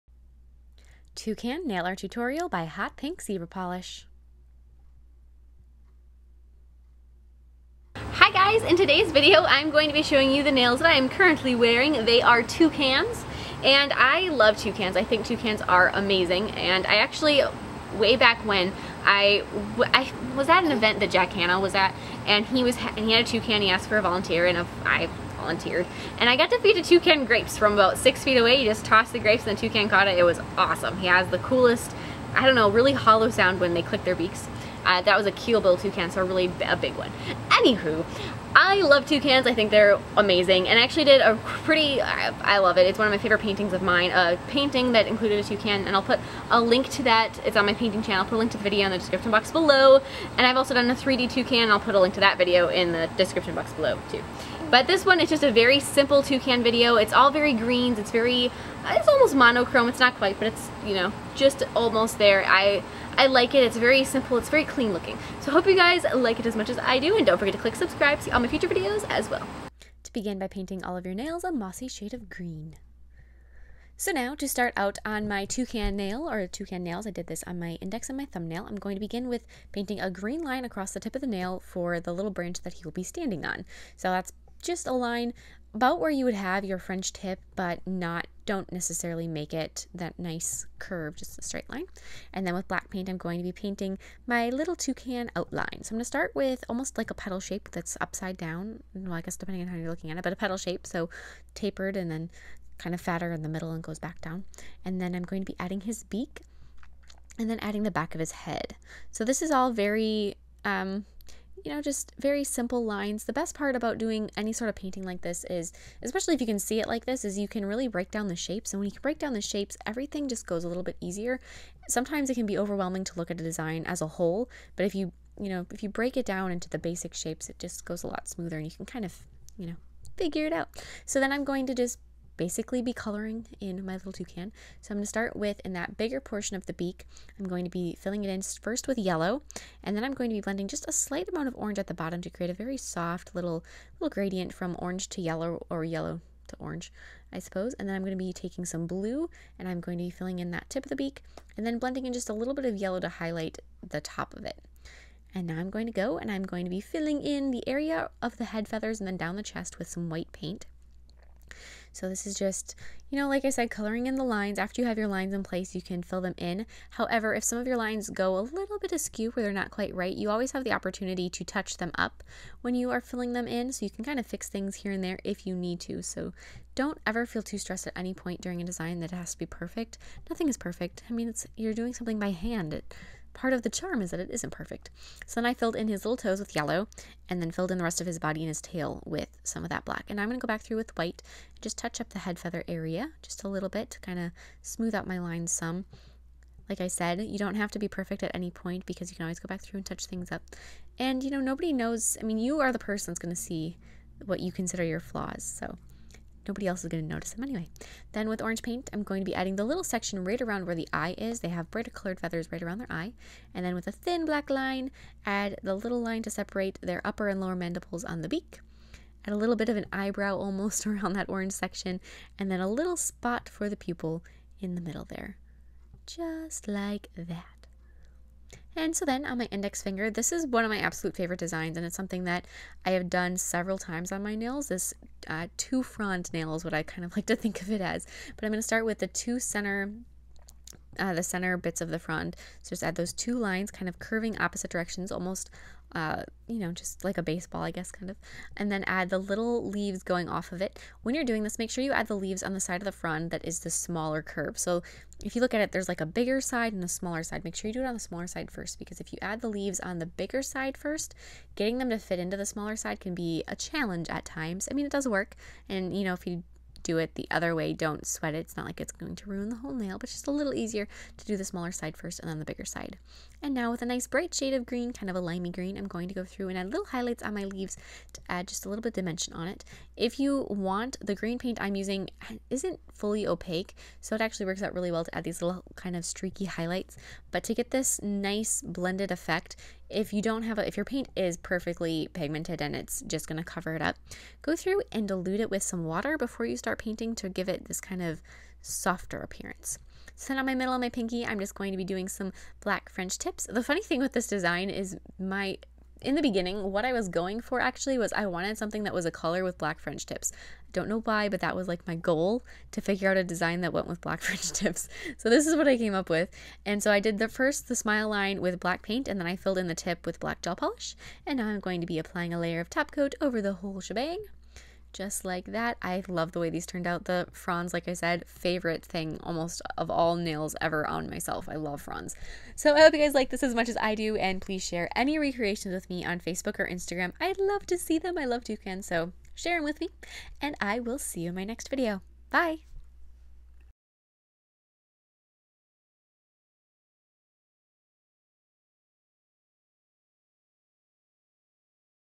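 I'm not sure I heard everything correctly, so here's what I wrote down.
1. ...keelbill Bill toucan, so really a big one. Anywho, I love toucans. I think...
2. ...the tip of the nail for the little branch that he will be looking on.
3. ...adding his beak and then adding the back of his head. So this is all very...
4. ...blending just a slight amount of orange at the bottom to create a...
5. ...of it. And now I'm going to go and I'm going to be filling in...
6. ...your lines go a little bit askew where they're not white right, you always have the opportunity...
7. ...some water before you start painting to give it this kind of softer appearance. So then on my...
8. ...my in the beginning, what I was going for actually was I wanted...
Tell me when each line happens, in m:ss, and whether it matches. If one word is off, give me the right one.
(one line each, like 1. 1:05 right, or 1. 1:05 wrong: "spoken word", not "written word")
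1. 0:35 right
2. 1:20 wrong: "standing", not "looking"
3. 1:45 right
4. 2:20 right
5. 2:34 right
6. 2:47 wrong: "quite", not "white"
7. 4:55 right
8. 5:05 right.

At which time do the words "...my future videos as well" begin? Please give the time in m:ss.
1:08.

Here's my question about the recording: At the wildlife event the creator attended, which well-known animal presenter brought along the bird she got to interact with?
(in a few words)
Jack Hanna.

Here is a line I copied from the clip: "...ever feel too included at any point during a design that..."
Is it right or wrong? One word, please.
wrong.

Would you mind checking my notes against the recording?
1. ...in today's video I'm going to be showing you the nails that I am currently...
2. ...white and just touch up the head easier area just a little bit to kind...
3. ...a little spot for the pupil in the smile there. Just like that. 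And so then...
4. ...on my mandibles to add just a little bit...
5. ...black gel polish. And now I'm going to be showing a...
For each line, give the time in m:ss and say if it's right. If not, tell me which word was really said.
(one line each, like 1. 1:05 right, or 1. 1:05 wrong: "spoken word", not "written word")
1. 0:08 right
2. 3:10 wrong: "feather", not "easier"
3. 3:42 wrong: "middle", not "smile"
4. 4:37 wrong: "leaves", not "mandibles"
5. 5:20 wrong: "applying", not "showing".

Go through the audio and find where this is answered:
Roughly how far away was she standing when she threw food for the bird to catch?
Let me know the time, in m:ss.
0:27.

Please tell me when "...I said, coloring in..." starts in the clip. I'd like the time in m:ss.
2:43.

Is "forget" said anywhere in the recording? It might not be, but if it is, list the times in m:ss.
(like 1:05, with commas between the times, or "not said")
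1:07.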